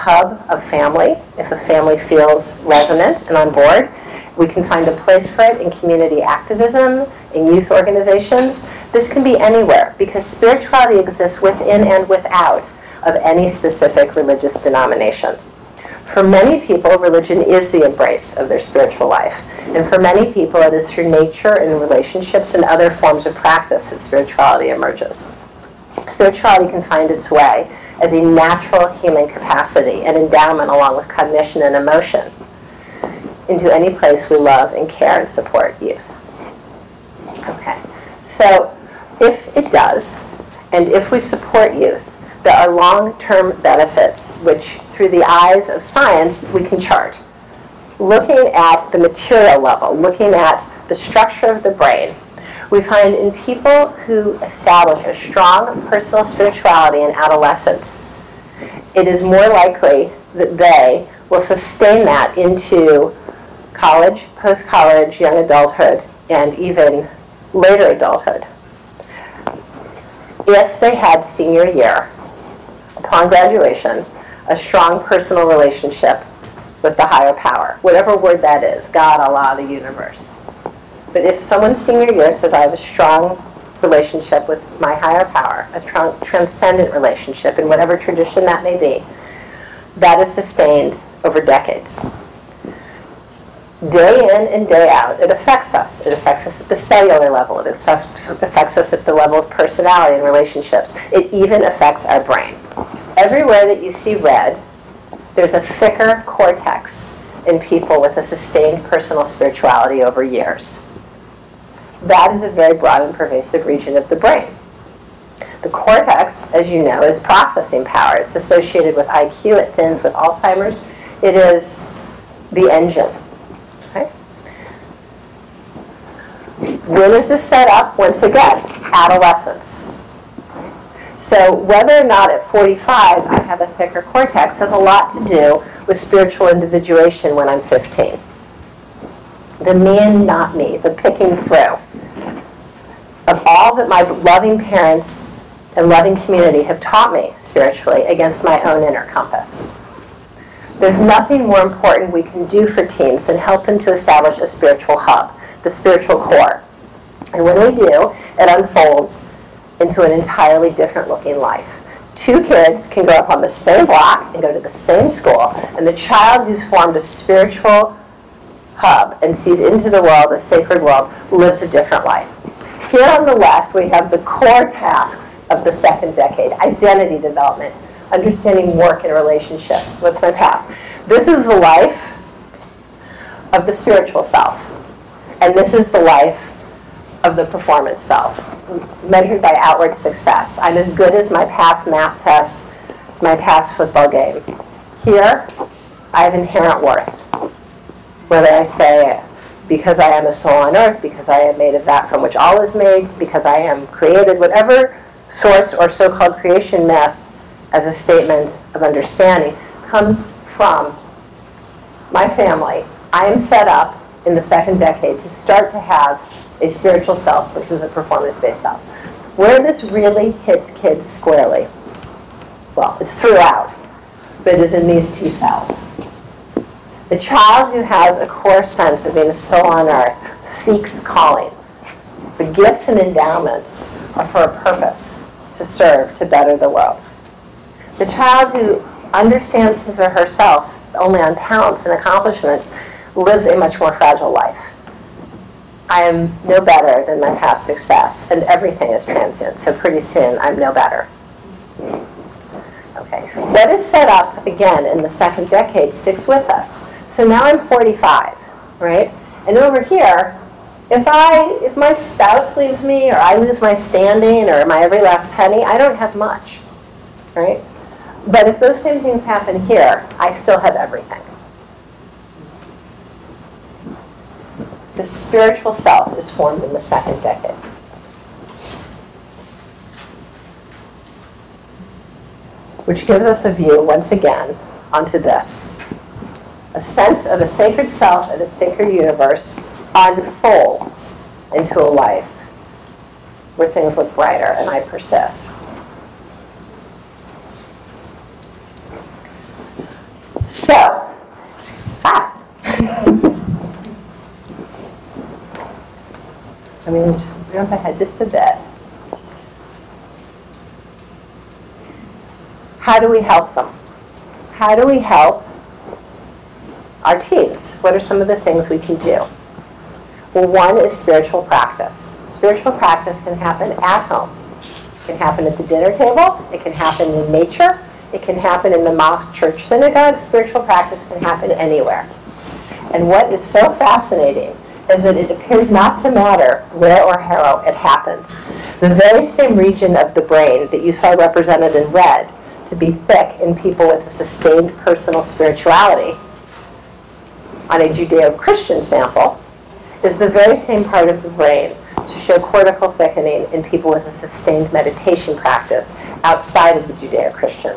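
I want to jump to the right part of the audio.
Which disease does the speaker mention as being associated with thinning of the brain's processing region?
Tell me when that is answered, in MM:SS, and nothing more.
02:00.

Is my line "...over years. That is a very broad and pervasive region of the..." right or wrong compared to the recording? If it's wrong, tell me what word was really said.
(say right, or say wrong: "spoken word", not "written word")
right.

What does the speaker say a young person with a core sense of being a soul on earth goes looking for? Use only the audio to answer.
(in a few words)
calling.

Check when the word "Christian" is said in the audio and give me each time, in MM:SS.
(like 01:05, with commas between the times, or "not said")
05:47, 05:56.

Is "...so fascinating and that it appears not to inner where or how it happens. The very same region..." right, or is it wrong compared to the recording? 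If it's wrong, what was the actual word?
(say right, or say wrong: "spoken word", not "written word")
wrong: "matter", not "inner".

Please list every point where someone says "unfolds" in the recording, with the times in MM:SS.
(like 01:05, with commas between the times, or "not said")
02:38, 04:49.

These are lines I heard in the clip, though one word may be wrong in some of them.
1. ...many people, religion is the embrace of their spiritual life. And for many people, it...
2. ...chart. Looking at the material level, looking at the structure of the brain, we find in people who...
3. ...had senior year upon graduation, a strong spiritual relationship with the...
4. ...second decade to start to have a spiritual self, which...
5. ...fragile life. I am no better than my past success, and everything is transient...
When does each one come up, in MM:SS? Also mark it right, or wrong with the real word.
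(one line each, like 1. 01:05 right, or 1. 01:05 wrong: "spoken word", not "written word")
1. 00:16 right
2. 00:46 right
3. 01:10 wrong: "personal", not "spiritual"
4. 03:34 right
5. 04:03 right.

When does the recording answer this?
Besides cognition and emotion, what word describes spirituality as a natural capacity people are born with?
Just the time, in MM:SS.
00:30.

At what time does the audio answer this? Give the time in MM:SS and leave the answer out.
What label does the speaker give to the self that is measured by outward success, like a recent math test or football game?
03:07.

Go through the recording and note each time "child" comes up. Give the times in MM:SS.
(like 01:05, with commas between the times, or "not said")
02:45, 03:47, 03:58.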